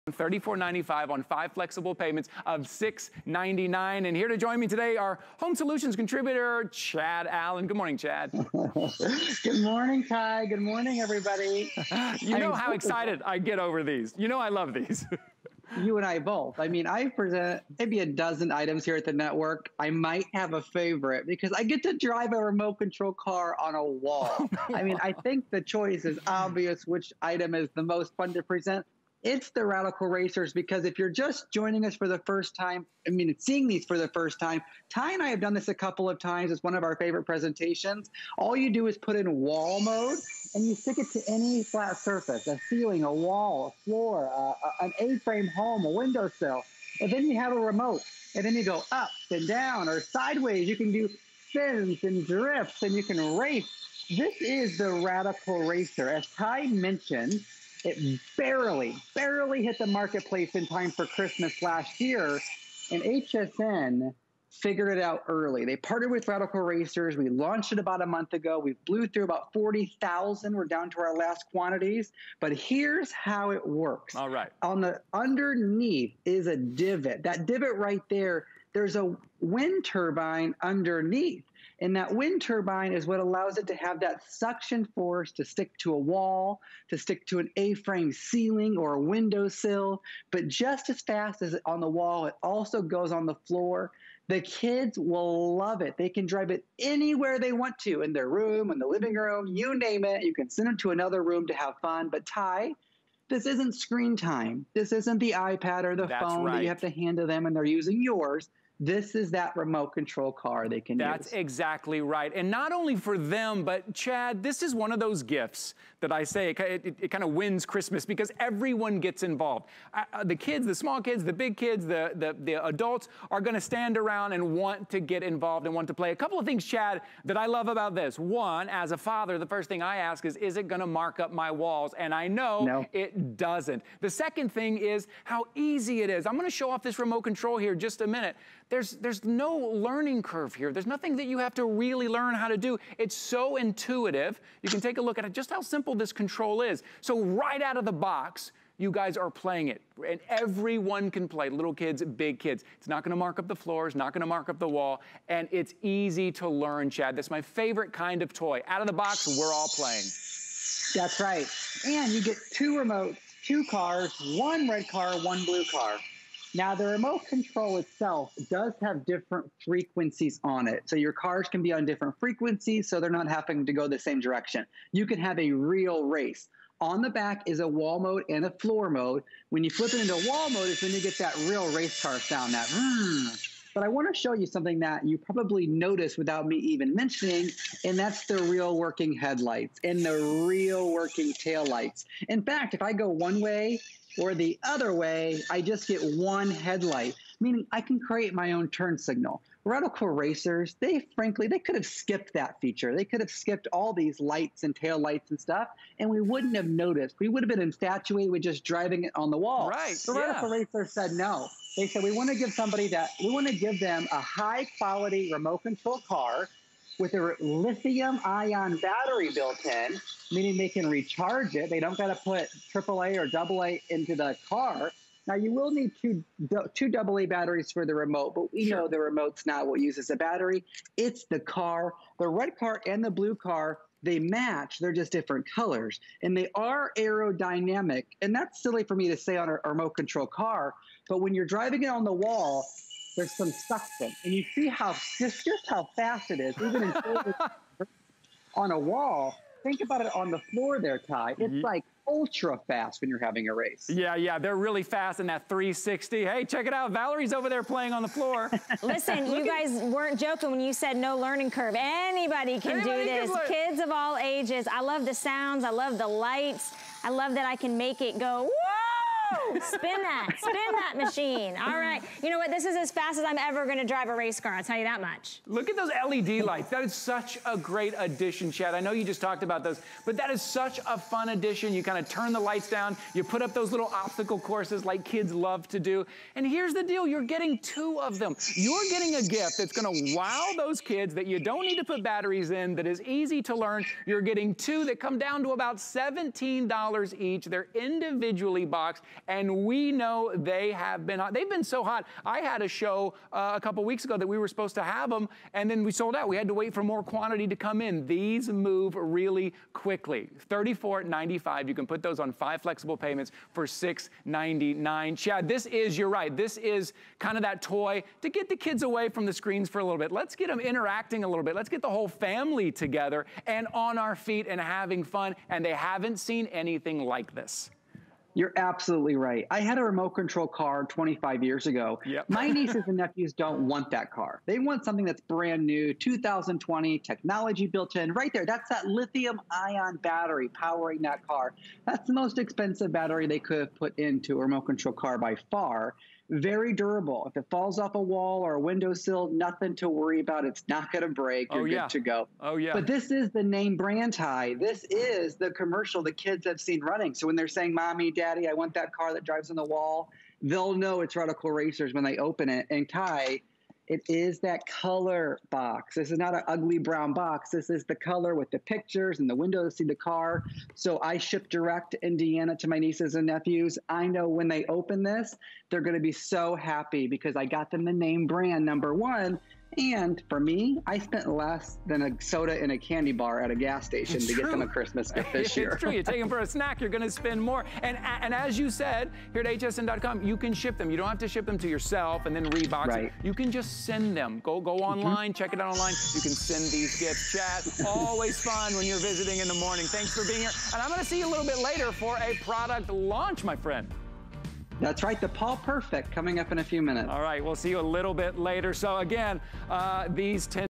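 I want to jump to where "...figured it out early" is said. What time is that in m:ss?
1:04.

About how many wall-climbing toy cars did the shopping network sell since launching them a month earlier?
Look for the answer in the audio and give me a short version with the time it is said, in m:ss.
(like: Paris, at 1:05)
40,000, at 1:09.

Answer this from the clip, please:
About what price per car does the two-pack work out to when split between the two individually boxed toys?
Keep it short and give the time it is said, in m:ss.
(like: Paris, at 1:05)
$17, at 4:55.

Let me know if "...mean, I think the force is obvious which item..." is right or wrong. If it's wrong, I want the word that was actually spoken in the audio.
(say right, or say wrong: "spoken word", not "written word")
wrong: "choice", not "force".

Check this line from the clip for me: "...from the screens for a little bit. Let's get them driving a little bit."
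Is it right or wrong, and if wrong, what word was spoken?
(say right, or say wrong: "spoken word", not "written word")
wrong: "interacting", not "driving".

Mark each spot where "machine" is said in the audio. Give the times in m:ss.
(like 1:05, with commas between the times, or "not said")
4:30.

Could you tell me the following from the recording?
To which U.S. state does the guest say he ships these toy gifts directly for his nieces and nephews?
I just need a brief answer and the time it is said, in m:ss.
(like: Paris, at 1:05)
Indiana, at 6:11.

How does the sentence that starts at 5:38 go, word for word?
Right there, that's that lithium ion battery powering that car.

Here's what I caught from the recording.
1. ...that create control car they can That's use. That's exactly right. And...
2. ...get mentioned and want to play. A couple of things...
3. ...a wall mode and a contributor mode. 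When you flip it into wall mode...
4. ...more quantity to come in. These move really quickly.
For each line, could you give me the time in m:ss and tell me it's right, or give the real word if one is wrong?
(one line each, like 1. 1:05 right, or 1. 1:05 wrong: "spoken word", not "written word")
1. 1:49 wrong: "remote", not "create"
2. 2:04 wrong: "involved", not "mentioned"
3. 2:57 wrong: "floor", not "contributor"
4. 5:06 right.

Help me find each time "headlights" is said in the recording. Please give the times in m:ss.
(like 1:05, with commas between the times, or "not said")
3:09, 3:16.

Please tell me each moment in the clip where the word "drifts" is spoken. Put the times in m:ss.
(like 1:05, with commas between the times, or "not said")
0:52.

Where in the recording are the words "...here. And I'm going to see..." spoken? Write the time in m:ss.
6:40.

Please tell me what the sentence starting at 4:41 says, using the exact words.
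You kind of turn the lights down.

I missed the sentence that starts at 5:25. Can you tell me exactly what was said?
And they haven't seen anything like this.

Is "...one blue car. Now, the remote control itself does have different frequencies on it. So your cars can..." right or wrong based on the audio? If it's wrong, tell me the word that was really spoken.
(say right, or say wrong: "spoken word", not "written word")
right.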